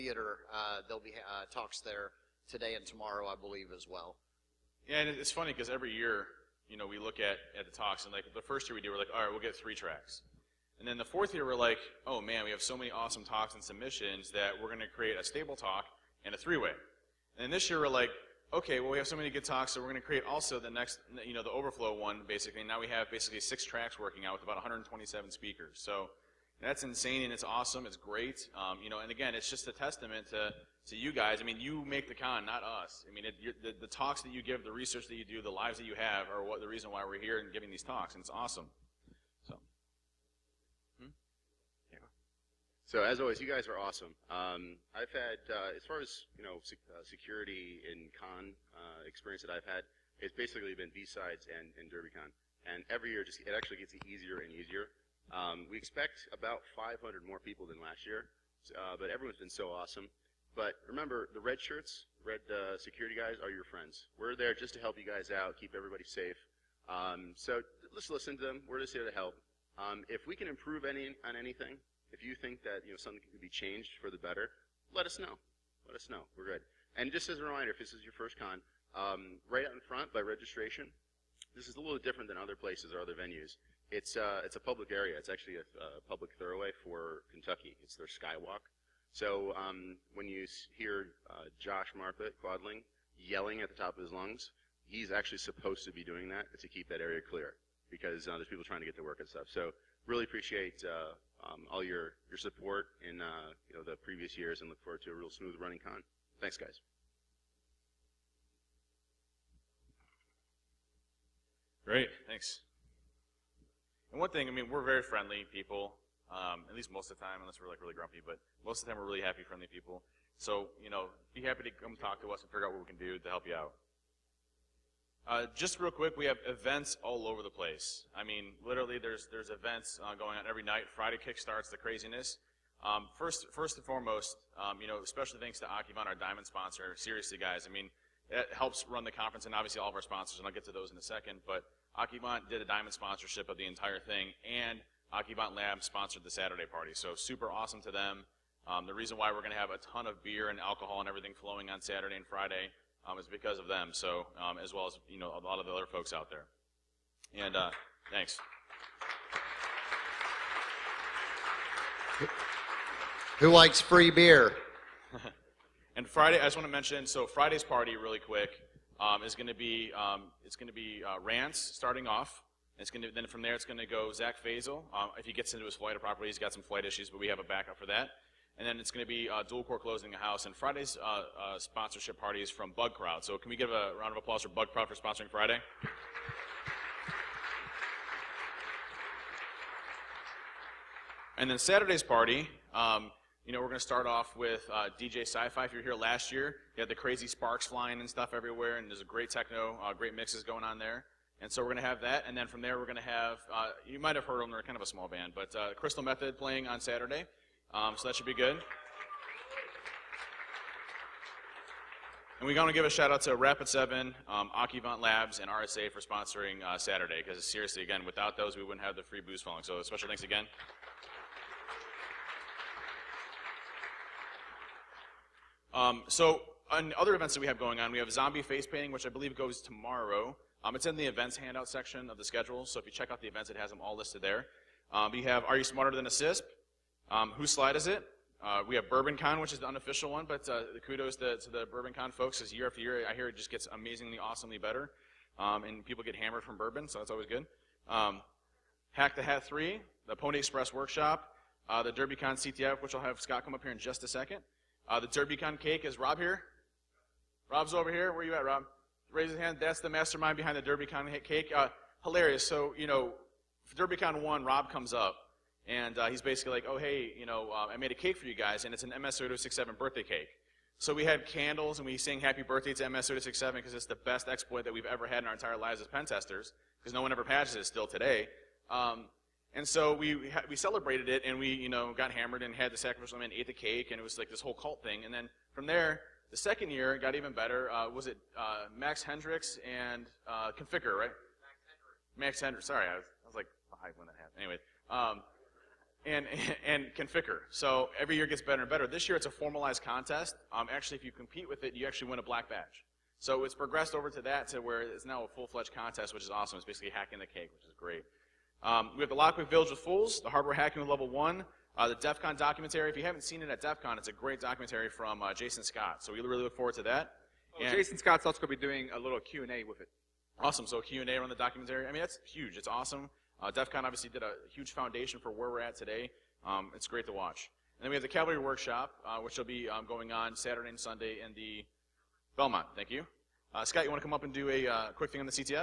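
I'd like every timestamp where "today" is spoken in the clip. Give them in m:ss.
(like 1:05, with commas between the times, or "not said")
0:02, 4:37, 5:25.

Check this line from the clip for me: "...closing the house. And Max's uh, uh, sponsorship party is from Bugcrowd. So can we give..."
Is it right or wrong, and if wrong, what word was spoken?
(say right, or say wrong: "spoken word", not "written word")
wrong: "Friday", not "Max".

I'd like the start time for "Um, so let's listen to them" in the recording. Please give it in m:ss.
1:06.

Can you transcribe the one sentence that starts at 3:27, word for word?
Um, so that should be good.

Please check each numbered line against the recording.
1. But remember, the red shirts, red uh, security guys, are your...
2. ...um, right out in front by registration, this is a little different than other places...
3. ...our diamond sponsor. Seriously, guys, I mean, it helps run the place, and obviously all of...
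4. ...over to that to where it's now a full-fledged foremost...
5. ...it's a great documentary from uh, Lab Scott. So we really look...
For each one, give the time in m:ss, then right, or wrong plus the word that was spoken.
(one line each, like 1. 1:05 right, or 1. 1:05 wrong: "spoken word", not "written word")
1. 1:00 right
2. 1:18 right
3. 2:16 wrong: "conference", not "place"
4. 5:03 wrong: "contest", not "foremost"
5. 5:13 wrong: "Jason", not "Lab".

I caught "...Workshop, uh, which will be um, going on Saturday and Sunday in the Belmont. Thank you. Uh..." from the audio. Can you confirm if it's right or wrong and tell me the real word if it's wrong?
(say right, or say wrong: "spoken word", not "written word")
right.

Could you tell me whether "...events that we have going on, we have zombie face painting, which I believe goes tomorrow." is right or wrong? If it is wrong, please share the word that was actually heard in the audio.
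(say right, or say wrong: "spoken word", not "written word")
right.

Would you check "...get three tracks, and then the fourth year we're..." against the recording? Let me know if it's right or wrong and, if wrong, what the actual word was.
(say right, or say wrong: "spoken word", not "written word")
right.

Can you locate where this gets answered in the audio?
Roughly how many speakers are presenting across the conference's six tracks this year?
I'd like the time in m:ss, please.
0:24.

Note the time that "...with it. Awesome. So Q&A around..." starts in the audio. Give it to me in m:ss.
5:19.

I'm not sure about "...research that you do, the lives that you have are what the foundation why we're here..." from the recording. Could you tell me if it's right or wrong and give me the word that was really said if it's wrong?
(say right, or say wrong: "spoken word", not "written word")
wrong: "reason", not "foundation".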